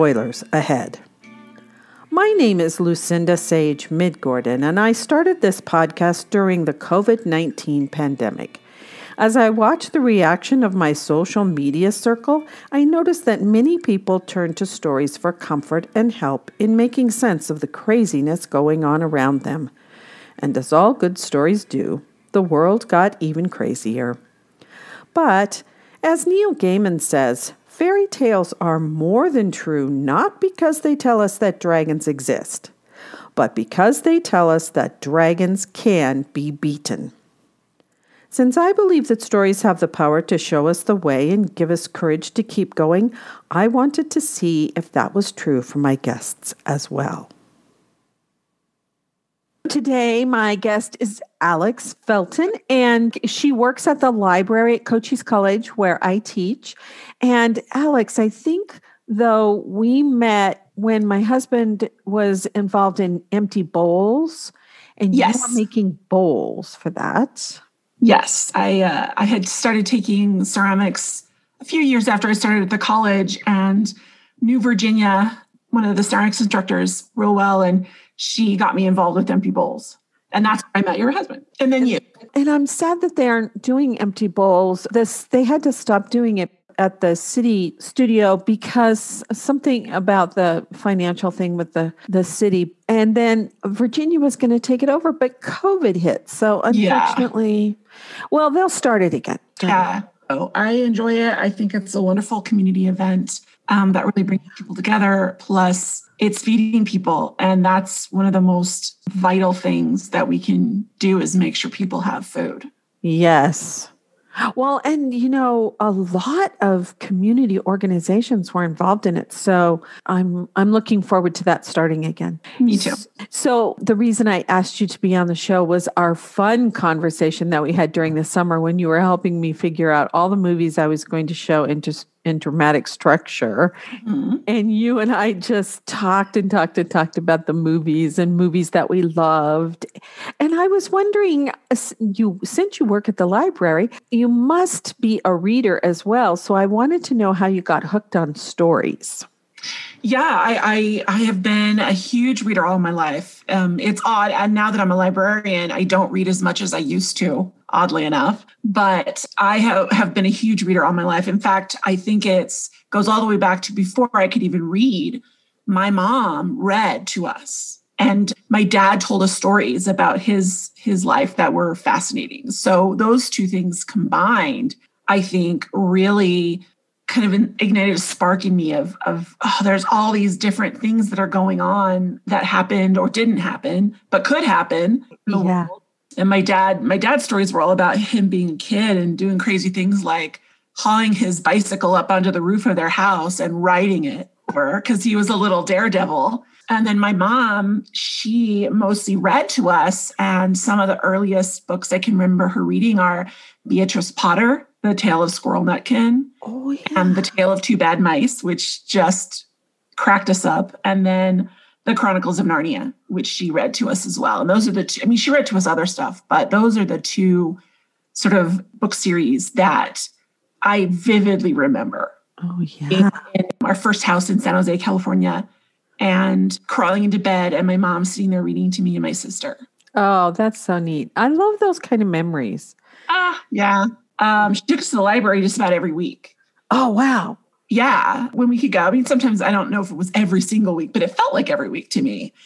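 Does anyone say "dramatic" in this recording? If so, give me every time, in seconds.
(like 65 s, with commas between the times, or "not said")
132 s.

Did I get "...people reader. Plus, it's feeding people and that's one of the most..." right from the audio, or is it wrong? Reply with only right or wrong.
wrong.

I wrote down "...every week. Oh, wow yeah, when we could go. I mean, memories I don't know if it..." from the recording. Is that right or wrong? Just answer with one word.
wrong.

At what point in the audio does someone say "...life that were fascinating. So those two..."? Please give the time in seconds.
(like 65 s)
171 s.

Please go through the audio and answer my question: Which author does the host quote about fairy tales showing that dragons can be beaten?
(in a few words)
Neil Gaiman.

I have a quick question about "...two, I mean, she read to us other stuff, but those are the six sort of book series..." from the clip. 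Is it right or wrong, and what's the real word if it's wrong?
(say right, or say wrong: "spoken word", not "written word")
wrong: "two", not "six".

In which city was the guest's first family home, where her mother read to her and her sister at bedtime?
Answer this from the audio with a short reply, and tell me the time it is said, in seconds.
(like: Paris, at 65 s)
San Jose, California, at 224 s.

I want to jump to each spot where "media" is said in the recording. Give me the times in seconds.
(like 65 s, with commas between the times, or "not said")
11 s.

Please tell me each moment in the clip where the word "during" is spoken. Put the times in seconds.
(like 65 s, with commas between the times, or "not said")
6 s, 127 s.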